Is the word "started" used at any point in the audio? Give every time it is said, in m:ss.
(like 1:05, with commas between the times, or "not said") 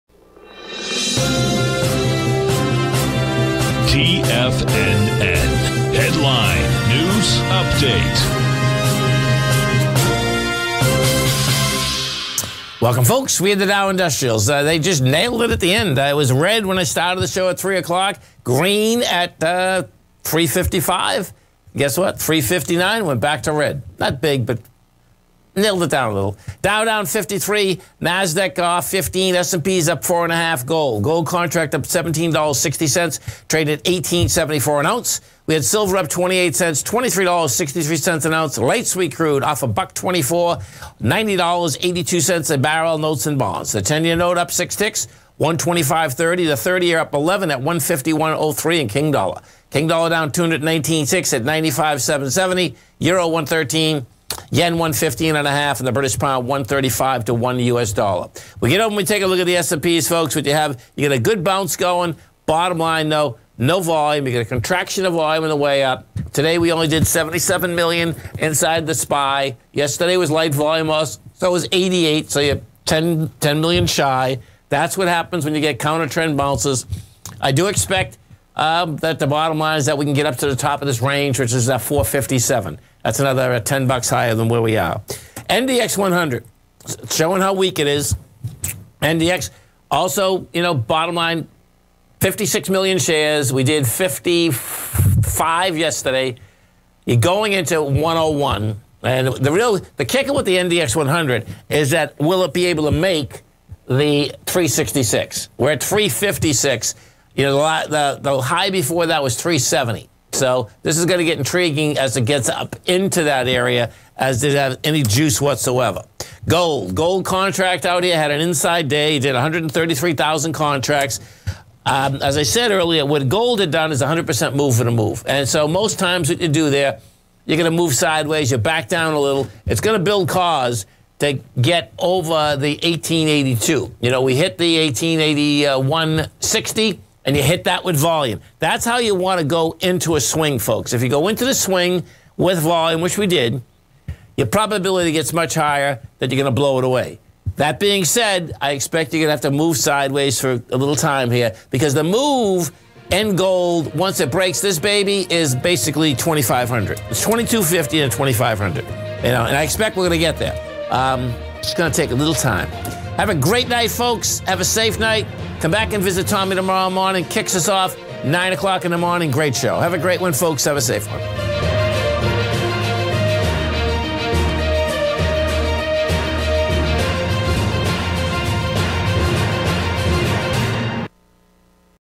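0:16.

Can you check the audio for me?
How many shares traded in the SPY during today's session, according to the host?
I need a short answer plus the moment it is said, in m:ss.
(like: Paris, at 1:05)
77 million, at 1:07.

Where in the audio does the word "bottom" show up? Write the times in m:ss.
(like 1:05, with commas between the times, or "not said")
1:02, 1:19, 1:30.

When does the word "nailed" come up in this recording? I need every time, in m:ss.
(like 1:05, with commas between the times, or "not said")
0:15, 0:25.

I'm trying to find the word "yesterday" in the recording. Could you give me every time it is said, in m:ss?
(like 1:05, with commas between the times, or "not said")
1:09, 1:35.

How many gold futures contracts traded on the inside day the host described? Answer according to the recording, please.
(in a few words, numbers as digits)
133,000.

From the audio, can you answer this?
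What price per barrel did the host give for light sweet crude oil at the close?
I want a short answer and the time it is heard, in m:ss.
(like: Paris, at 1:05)
$90.82, at 0:41.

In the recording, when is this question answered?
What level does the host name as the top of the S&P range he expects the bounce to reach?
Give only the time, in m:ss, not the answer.
1:21.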